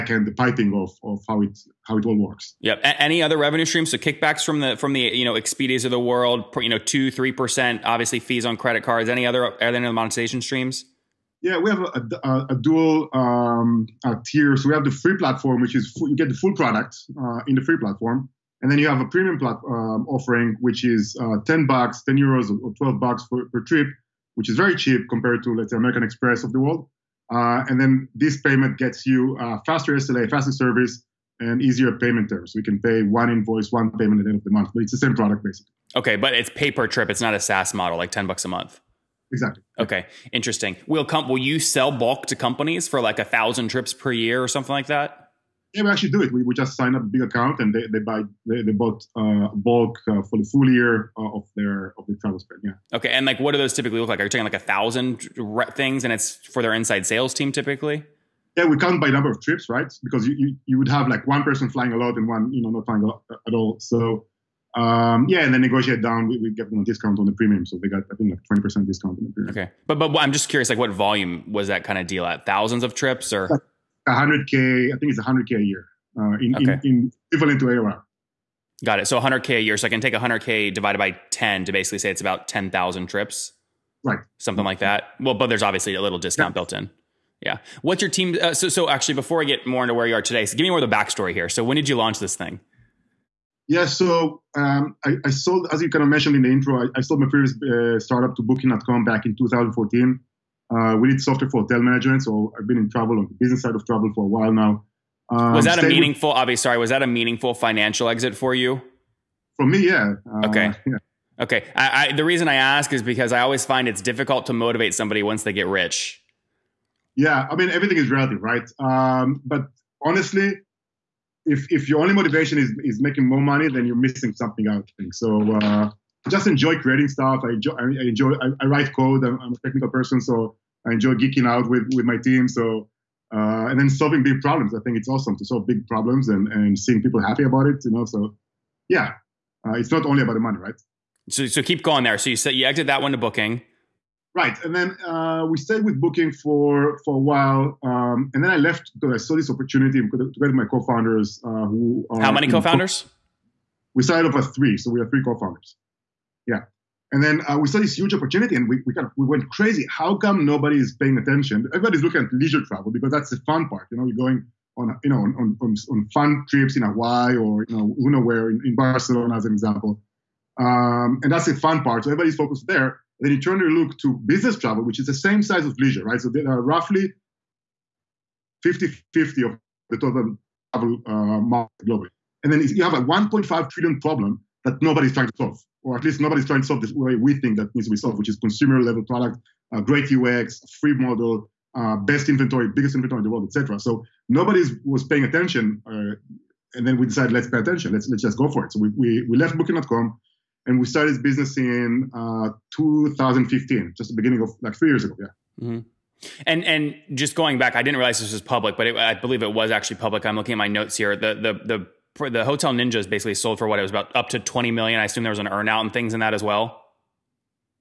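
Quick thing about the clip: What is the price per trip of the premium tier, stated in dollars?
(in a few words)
12 dollars.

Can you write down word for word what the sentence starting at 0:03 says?
So kickbacks from the from the you know Expedias of the world, you know two three percent, obviously fees on credit cards.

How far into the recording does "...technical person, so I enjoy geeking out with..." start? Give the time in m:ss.
2:09.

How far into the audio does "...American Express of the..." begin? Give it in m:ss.
0:25.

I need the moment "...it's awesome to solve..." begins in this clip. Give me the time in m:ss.
2:14.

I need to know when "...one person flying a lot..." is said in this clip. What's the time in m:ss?
1:01.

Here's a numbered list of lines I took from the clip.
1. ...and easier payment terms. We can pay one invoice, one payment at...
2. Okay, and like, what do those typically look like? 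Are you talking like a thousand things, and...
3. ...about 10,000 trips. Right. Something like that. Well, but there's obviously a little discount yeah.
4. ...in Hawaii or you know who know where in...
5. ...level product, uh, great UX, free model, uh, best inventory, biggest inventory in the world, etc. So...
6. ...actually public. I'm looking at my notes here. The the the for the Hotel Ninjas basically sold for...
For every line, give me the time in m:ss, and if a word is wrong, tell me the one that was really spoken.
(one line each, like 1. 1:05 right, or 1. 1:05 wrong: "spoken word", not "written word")
1. 0:31 right
2. 0:52 right
3. 1:22 right
4. 2:46 right
5. 3:08 right
6. 3:29 right.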